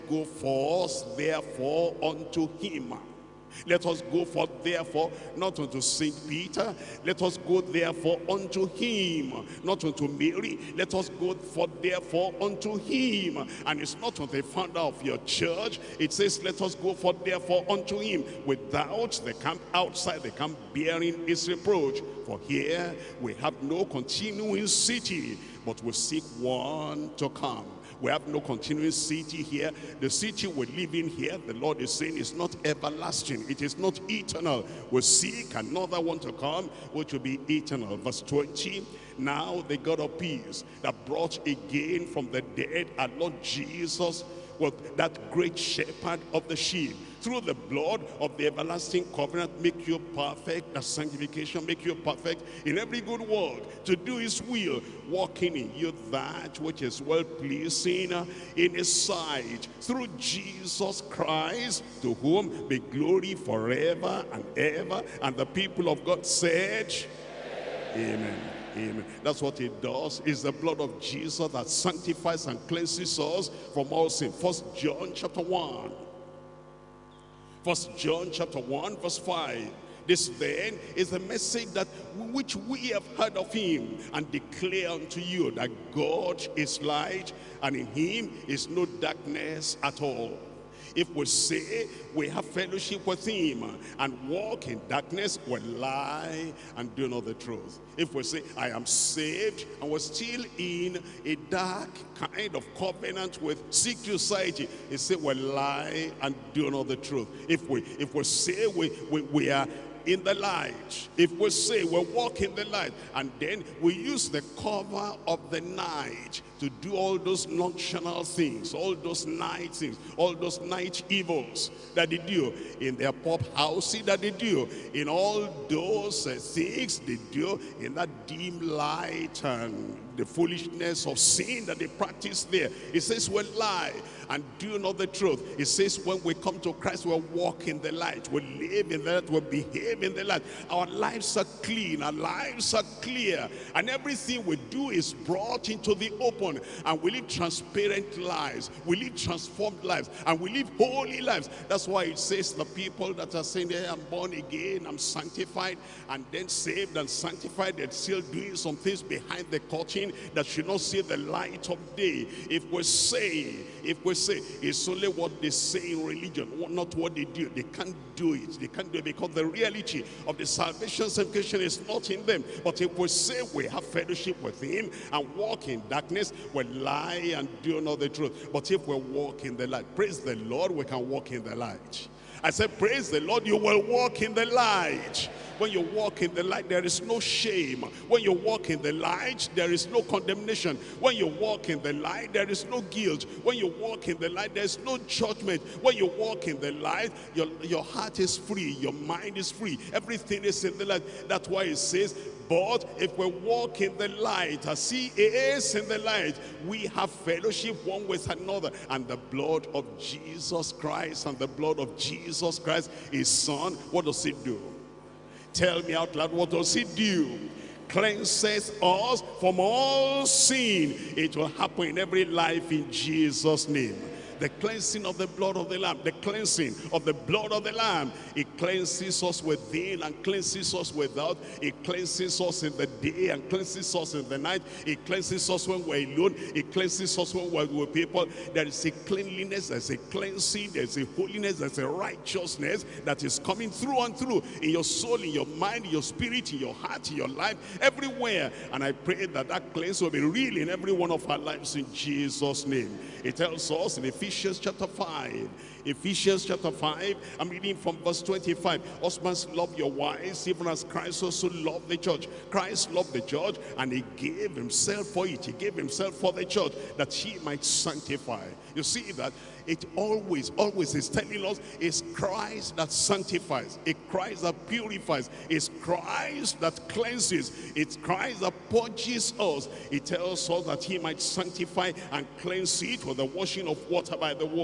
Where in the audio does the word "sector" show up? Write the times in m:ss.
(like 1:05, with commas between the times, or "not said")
not said.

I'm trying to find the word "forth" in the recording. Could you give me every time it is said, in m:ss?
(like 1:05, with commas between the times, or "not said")
0:00, 0:04, 0:11, 0:16.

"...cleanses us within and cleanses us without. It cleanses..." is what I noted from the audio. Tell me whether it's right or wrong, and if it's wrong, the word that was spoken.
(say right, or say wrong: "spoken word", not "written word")
right.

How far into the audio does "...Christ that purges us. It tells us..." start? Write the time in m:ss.
4:37.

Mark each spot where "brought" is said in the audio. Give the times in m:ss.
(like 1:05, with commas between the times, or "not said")
0:41, 2:25.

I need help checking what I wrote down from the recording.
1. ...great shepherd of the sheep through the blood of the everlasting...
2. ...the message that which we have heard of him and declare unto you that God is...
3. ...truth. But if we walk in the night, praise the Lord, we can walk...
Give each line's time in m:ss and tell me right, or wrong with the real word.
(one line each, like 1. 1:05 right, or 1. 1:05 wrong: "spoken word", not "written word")
1. 0:45 right
2. 1:21 right
3. 2:58 wrong: "light", not "night".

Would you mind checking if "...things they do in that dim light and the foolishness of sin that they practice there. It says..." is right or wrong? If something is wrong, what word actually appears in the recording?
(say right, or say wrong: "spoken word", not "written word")
right.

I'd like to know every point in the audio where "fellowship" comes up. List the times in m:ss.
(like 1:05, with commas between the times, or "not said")
1:32, 2:53, 3:27.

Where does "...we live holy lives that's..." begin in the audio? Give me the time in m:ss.
2:30.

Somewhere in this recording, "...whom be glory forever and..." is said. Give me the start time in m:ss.
1:02.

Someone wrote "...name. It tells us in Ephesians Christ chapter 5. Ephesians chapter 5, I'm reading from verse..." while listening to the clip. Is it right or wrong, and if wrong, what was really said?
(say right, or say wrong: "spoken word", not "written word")
wrong: "Ephesians", not "Christ".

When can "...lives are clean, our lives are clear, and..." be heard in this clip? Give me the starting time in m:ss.
2:20.